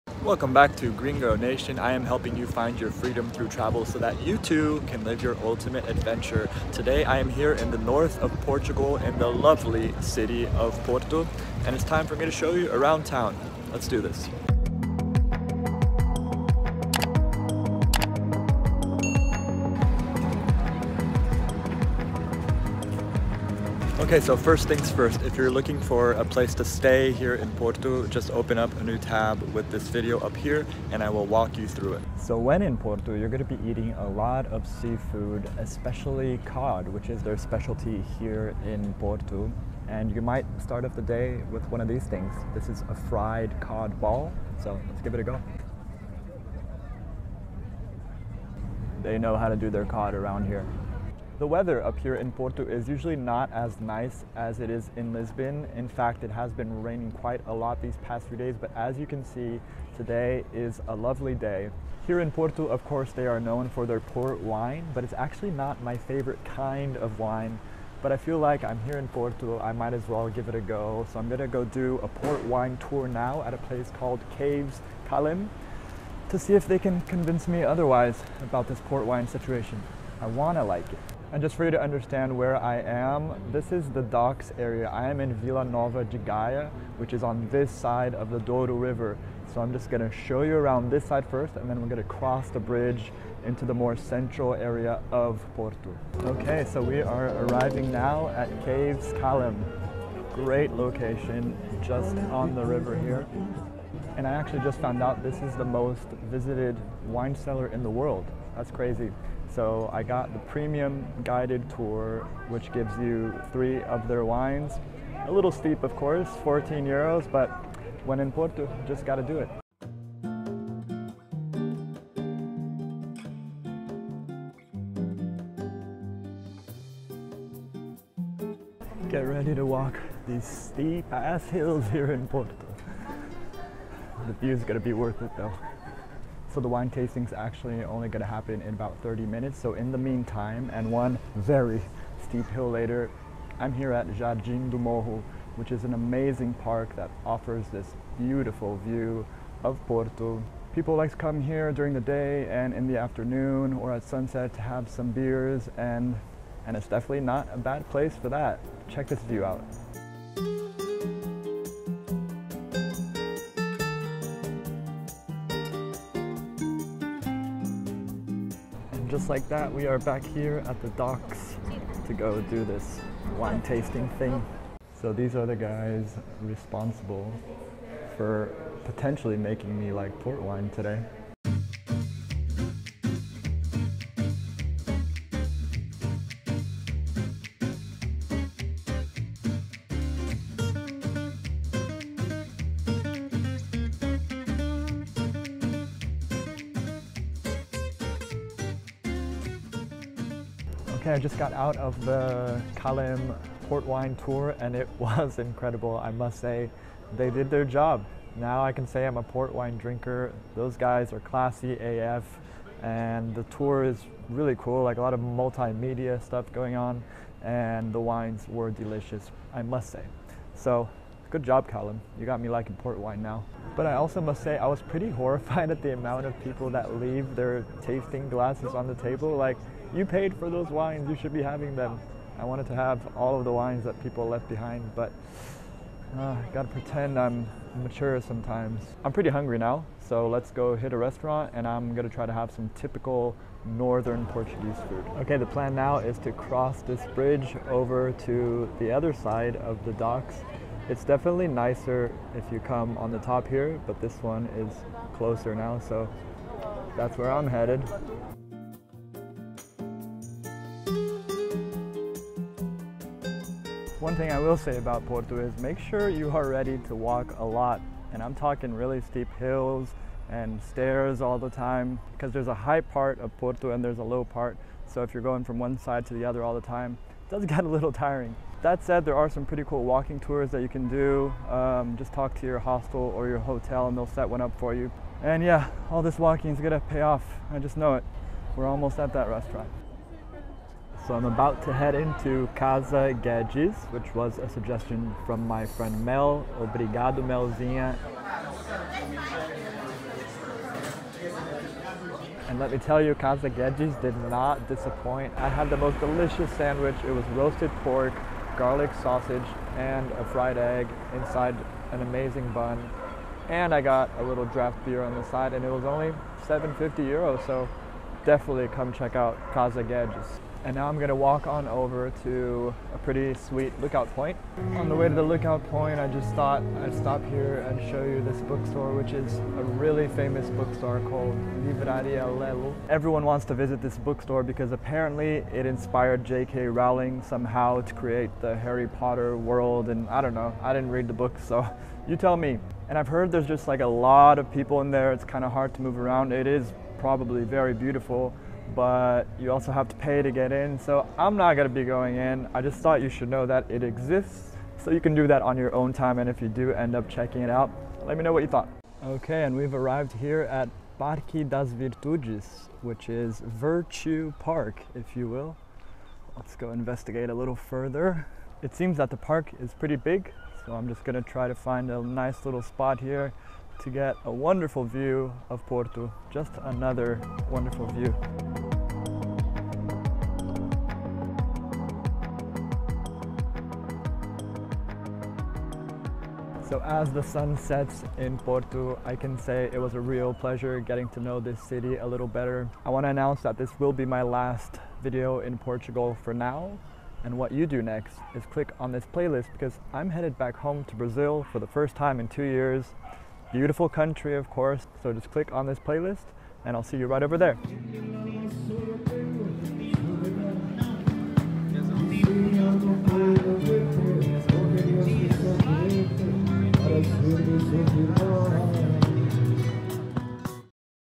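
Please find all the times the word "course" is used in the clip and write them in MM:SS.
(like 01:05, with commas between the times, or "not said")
01:02, 01:55, 06:44.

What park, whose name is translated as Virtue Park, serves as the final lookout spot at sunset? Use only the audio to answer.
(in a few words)
Parque das Virtudes.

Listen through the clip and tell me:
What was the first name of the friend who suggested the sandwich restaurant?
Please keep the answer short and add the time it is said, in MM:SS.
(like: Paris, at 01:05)
Mel, at 04:56.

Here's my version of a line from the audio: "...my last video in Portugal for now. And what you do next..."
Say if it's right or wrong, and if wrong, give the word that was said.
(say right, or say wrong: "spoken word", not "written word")
right.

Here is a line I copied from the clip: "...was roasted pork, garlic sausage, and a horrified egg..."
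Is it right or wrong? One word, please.
wrong.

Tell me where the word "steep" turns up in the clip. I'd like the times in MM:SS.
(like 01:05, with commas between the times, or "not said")
01:55, 02:10, 02:22, 04:28.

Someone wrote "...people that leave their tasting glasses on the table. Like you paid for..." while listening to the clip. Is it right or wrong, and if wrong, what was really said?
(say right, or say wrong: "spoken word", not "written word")
right.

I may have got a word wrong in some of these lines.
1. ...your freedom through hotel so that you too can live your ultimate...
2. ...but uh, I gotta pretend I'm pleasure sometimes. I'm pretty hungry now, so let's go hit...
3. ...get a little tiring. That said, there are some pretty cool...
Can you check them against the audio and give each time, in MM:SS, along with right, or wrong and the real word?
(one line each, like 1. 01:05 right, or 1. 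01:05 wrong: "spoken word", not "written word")
1. 00:02 wrong: "travel", not "hotel"
2. 03:54 wrong: "mature", not "pleasure"
3. 04:37 right.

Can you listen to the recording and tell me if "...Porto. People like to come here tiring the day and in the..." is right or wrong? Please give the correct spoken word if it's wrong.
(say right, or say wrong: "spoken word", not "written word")
wrong: "during", not "tiring".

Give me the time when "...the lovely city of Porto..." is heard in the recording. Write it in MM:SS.
00:09.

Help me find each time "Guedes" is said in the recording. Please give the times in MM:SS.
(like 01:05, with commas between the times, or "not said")
04:53, 05:03, 05:19.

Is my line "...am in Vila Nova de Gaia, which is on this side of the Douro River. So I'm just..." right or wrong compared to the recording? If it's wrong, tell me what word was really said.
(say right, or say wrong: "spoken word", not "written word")
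right.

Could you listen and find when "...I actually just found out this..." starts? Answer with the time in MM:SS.
01:44.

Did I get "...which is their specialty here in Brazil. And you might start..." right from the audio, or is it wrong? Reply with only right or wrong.
wrong.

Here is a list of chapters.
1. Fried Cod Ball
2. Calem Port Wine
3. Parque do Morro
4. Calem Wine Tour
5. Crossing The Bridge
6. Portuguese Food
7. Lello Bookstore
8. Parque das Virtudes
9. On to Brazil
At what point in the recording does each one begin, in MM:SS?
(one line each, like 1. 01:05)
1. 00:31
2. 01:02
3. 01:59
4. 02:55
5. 03:58
6. 04:50
7. 05:24
8. 05:59
9. 06:32.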